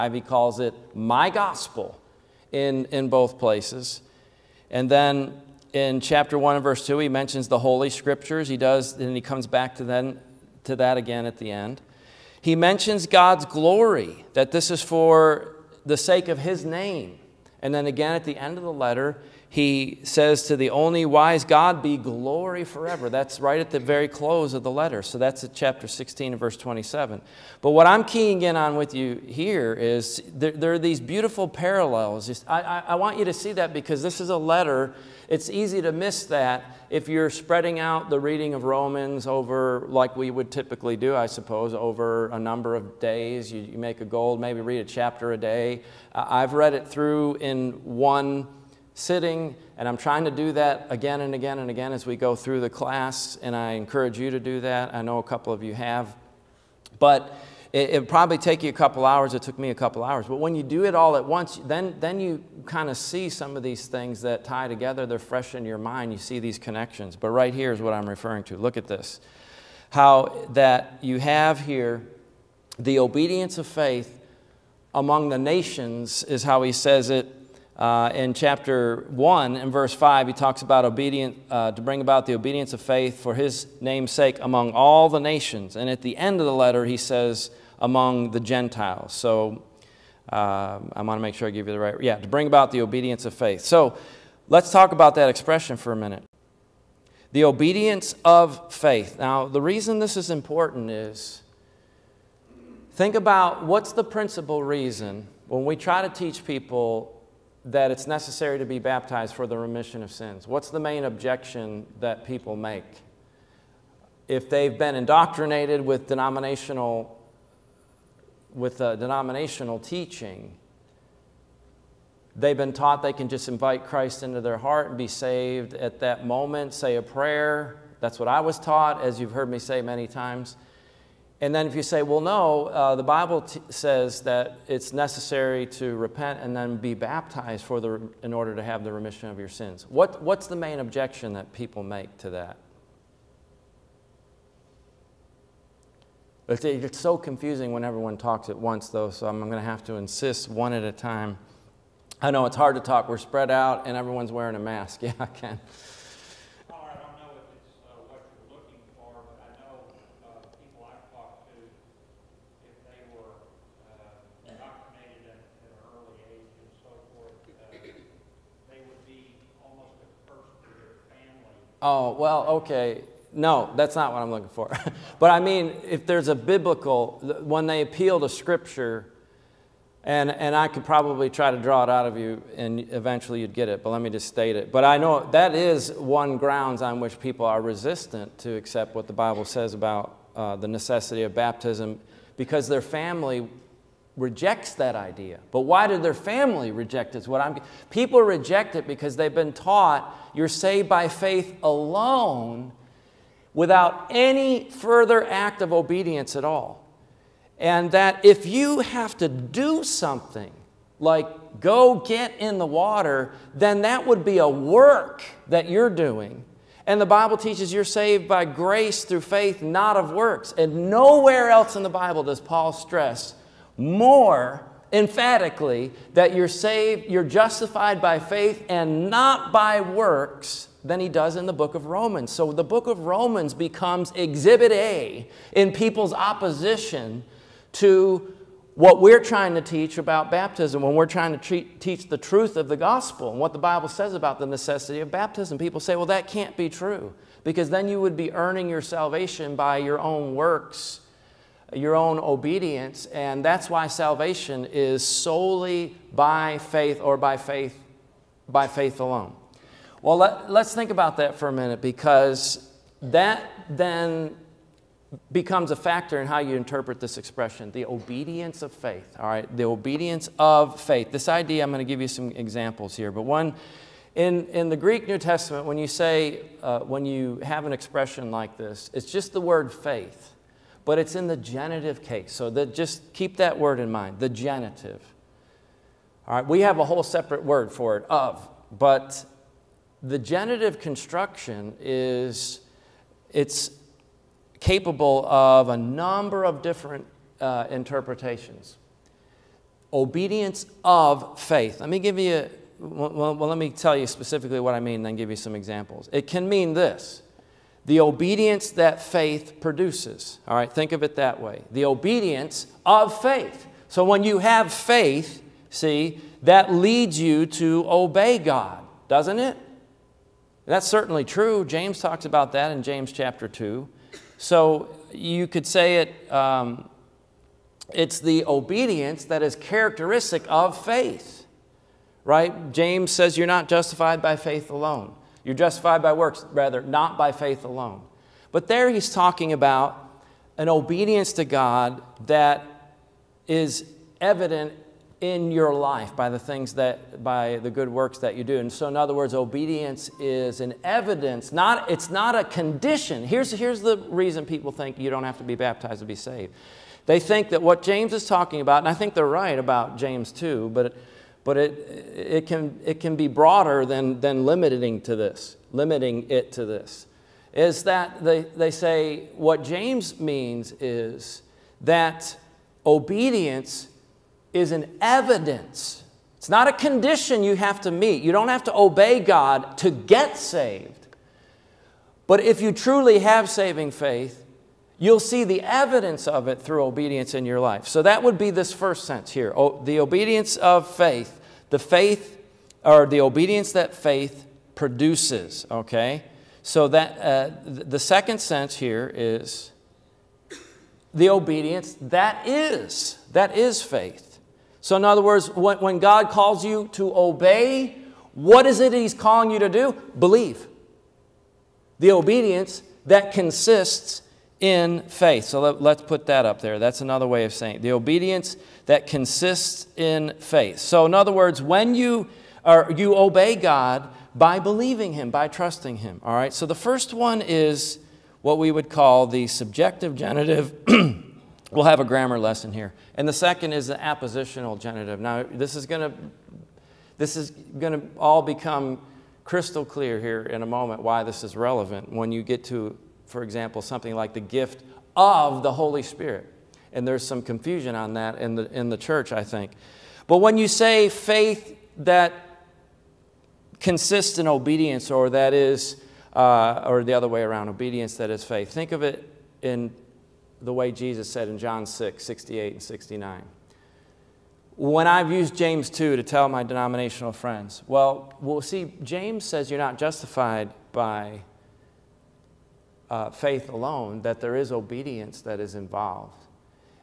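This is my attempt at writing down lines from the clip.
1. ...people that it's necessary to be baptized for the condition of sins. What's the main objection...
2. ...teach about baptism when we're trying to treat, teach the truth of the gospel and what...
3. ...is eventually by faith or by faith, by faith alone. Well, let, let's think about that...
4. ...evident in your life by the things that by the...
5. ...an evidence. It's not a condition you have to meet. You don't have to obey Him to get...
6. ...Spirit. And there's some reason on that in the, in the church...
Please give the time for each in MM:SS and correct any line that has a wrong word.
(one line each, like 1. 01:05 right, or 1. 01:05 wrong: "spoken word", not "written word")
1. 01:46 wrong: "remission", not "condition"
2. 03:59 right
3. 04:14 wrong: "solely", not "eventually"
4. 05:44 right
5. 06:14 wrong: "God", not "Him"
6. 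07:26 wrong: "confusion", not "reason".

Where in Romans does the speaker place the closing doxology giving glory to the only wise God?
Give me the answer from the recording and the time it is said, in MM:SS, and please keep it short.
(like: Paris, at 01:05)
Chapter 16 verse 27, at 00:25.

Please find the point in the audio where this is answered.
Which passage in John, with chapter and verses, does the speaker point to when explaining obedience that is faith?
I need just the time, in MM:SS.
07:41.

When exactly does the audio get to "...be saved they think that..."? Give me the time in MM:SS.
05:56.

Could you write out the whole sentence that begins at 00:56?
But it, would probably take you a couple hours.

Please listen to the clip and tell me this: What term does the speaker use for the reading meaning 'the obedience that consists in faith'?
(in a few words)
Appositional genitive.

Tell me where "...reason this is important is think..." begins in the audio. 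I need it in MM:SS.
01:39.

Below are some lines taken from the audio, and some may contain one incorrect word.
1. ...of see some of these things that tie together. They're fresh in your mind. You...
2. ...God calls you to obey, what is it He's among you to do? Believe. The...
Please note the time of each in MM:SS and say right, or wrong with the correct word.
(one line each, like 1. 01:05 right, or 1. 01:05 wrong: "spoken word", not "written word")
1. 01:02 right
2. 06:45 wrong: "calling", not "among".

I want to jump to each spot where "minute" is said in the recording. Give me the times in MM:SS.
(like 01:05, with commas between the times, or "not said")
01:35, 04:21.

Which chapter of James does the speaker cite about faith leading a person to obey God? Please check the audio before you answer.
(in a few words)
Chapter 2.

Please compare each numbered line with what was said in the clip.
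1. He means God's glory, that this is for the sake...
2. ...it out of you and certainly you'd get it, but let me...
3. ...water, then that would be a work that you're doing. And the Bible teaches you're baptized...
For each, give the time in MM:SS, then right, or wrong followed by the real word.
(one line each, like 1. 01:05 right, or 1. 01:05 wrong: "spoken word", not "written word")
1. 00:12 wrong: "mentions", not "means"
2. 03:01 wrong: "eventually", not "certainly"
3. 03:32 wrong: "saved", not "baptized".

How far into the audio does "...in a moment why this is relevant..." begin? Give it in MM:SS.
07:20.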